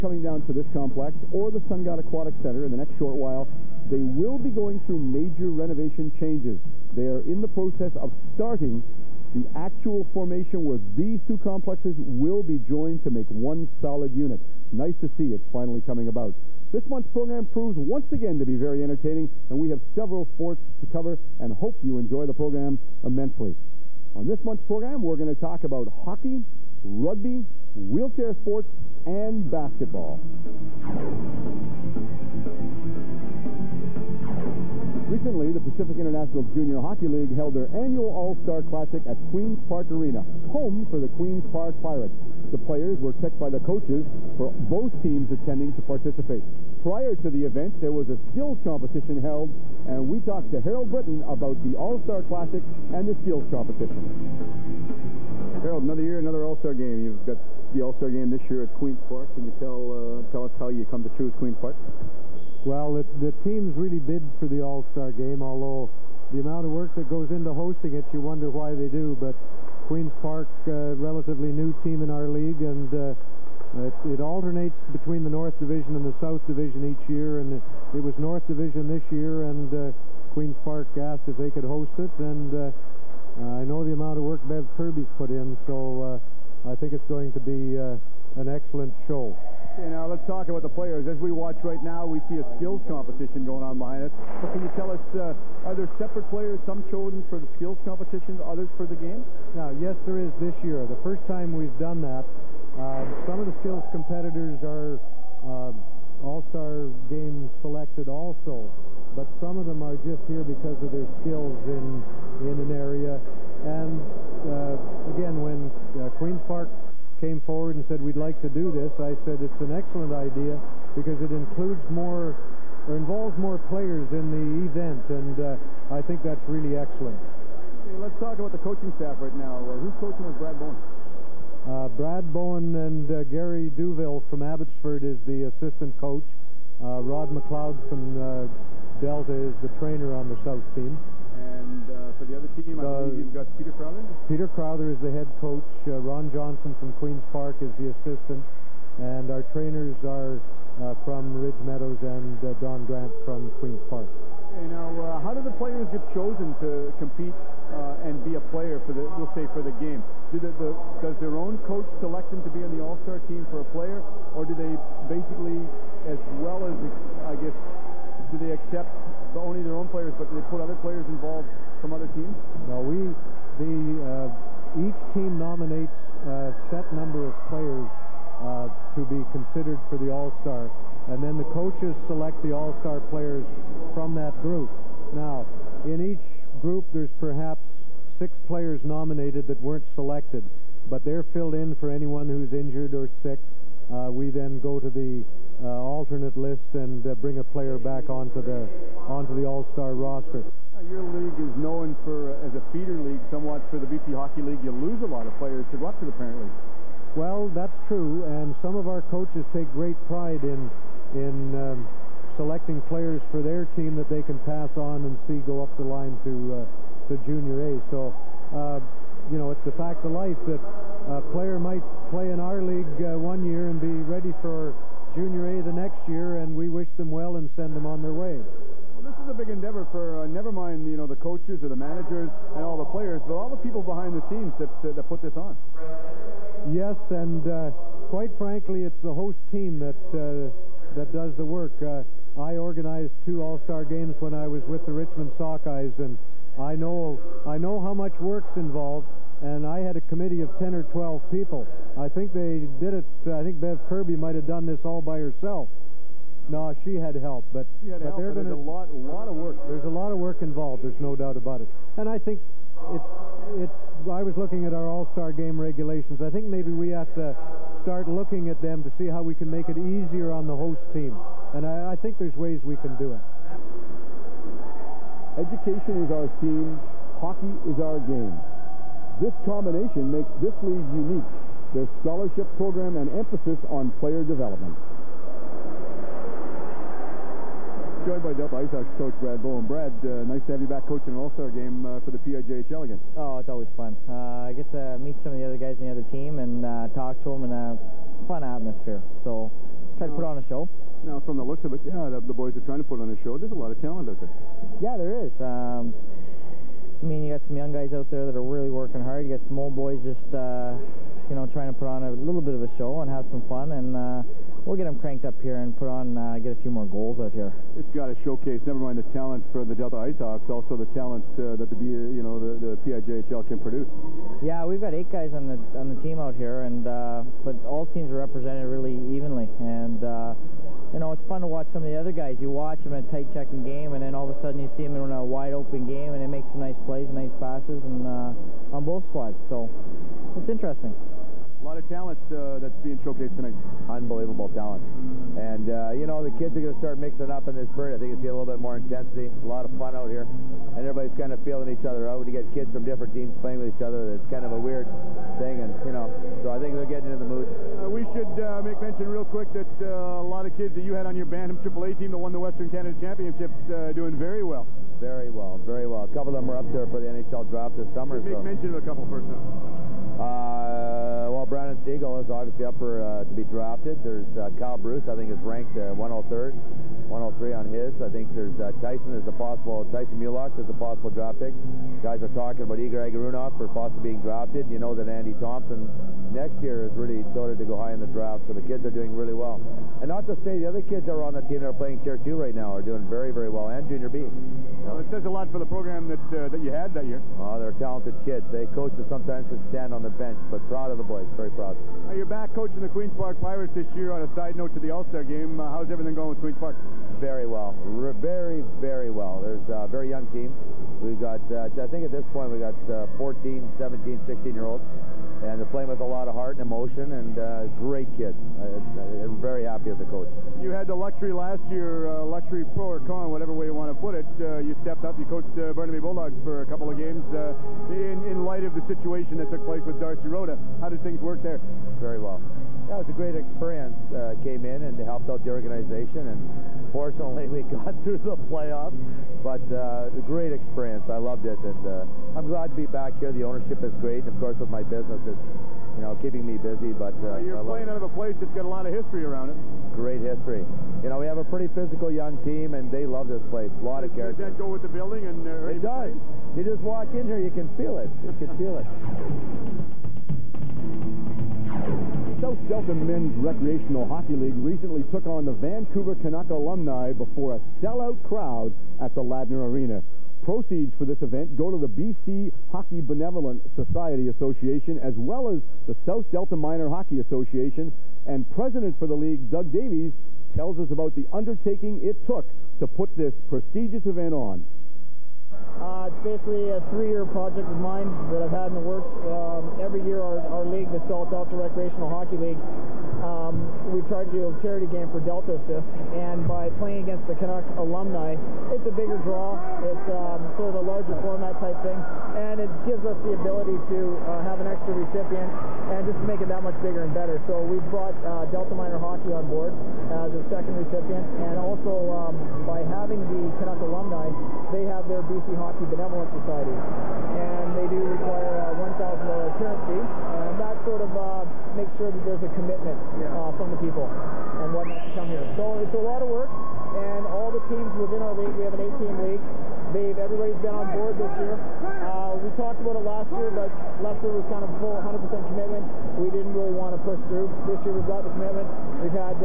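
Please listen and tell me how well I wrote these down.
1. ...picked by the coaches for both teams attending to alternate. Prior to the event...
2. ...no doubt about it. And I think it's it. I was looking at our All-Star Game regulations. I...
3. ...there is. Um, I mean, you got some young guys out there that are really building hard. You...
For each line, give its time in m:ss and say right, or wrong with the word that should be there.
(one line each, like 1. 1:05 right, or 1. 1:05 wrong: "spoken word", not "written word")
1. 0:43 wrong: "participate", not "alternate"
2. 4:20 right
3. 5:04 wrong: "working", not "building".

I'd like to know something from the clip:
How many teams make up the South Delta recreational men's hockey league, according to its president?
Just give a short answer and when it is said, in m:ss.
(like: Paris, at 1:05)
18, at 8:48.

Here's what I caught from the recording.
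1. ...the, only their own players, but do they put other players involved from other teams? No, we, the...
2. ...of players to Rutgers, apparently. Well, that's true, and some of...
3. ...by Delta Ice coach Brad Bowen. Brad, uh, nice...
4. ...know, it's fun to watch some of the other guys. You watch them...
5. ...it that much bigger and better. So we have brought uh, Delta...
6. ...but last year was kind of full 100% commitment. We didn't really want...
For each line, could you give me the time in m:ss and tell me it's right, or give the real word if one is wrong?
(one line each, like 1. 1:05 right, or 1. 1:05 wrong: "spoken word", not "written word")
1. 2:49 right
2. 3:25 right
3. 4:48 right
4. 5:30 right
5. 8:26 right
6. 8:53 right.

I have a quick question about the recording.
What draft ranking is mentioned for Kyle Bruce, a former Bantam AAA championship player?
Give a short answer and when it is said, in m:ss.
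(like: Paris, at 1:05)
103rd, at 6:15.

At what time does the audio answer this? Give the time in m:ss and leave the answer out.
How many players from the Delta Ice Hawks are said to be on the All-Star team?
5:24.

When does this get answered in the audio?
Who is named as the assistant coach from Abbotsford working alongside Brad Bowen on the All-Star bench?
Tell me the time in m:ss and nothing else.
2:13.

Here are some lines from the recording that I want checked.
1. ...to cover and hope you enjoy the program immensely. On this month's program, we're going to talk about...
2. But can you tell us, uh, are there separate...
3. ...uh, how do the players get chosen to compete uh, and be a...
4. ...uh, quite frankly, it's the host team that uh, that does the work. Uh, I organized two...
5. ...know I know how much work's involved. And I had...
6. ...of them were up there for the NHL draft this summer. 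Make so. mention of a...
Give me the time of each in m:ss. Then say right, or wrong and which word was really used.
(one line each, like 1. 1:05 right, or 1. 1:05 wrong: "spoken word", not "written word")
1. 0:20 right
2. 1:34 right
3. 2:35 right
4. 3:57 right
5. 4:06 right
6. 6:06 right.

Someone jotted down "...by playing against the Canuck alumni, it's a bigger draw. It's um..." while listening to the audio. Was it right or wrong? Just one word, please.
right.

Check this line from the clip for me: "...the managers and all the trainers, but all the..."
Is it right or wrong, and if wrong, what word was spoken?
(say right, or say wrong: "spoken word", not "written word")
wrong: "players", not "trainers".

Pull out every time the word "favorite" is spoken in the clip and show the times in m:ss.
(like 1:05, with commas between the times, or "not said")
not said.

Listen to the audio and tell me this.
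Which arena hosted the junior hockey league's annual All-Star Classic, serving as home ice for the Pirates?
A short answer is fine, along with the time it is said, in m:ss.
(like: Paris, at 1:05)
Queen's Park Arena, at 0:39.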